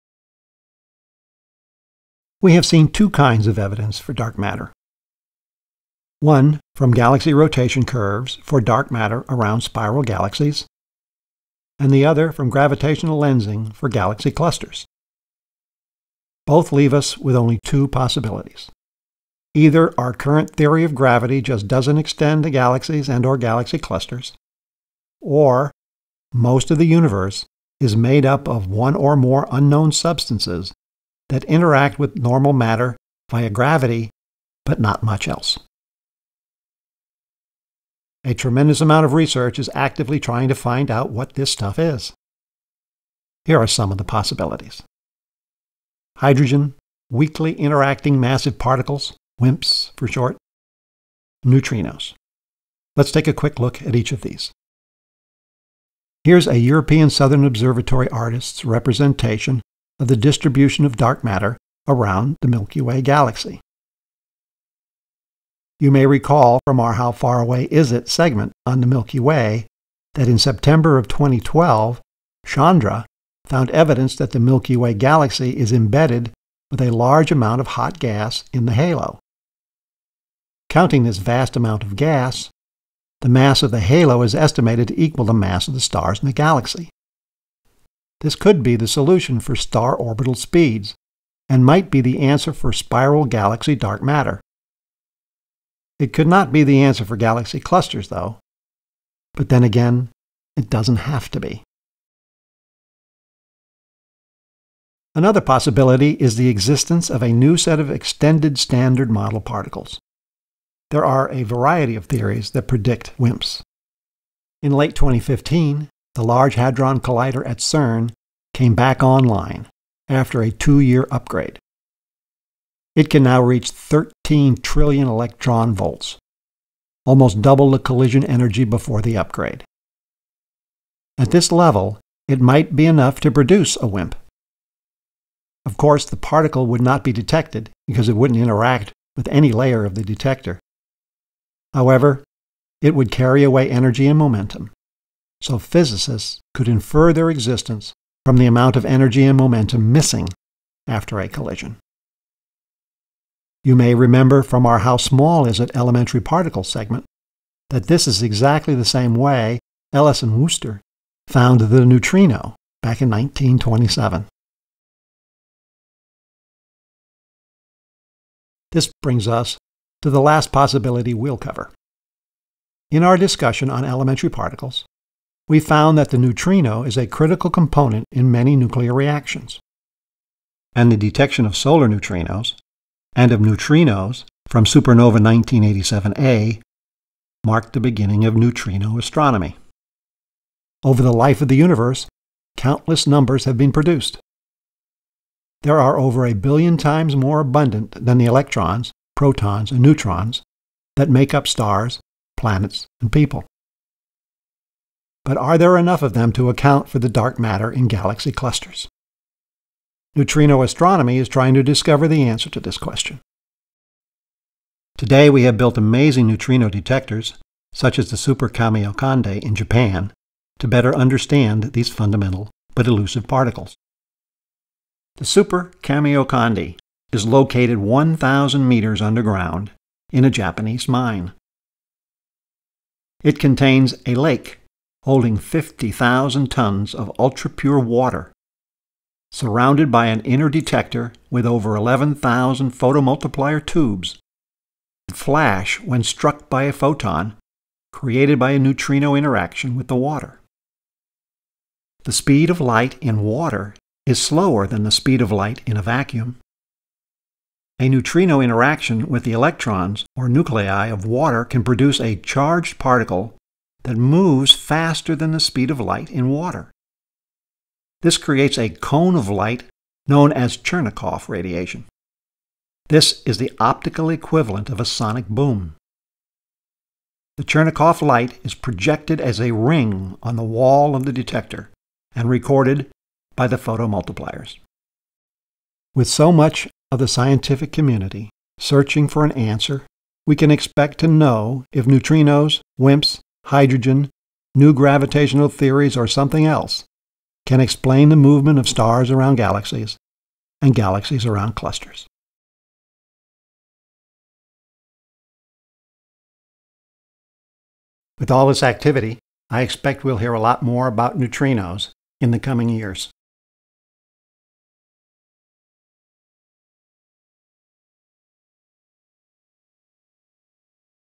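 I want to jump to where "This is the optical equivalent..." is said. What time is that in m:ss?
4:32.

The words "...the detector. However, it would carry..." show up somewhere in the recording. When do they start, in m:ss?
2:19.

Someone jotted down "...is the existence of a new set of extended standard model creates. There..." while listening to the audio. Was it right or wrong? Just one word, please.
wrong.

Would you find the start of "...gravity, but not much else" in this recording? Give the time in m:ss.
0:33.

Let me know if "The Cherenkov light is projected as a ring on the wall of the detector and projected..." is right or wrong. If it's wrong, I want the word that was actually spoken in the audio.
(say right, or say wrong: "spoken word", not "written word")
wrong: "recorded", not "projected".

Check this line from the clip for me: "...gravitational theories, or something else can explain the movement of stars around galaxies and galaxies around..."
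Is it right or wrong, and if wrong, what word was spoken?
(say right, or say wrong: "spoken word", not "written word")
right.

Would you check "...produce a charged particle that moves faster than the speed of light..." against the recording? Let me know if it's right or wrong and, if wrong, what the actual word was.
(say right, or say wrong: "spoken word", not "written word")
right.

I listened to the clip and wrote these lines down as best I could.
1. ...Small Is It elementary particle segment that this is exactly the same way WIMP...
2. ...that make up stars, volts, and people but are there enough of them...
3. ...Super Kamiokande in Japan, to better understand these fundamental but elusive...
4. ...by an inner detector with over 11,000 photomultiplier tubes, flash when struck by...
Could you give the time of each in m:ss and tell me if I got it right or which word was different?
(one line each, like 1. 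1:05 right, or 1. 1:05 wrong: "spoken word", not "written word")
1. 2:34 wrong: "Ellis", not "WIMP"
2. 3:20 wrong: "planets", not "volts"
3. 3:38 right
4. 3:59 right.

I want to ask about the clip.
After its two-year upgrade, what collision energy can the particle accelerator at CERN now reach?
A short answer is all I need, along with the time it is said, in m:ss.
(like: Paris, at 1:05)
13 trillion electron volts, at 2:03.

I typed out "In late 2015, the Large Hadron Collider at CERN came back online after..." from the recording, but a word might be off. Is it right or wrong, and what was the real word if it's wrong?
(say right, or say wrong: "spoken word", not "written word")
right.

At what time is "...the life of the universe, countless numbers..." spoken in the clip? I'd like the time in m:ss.
3:11.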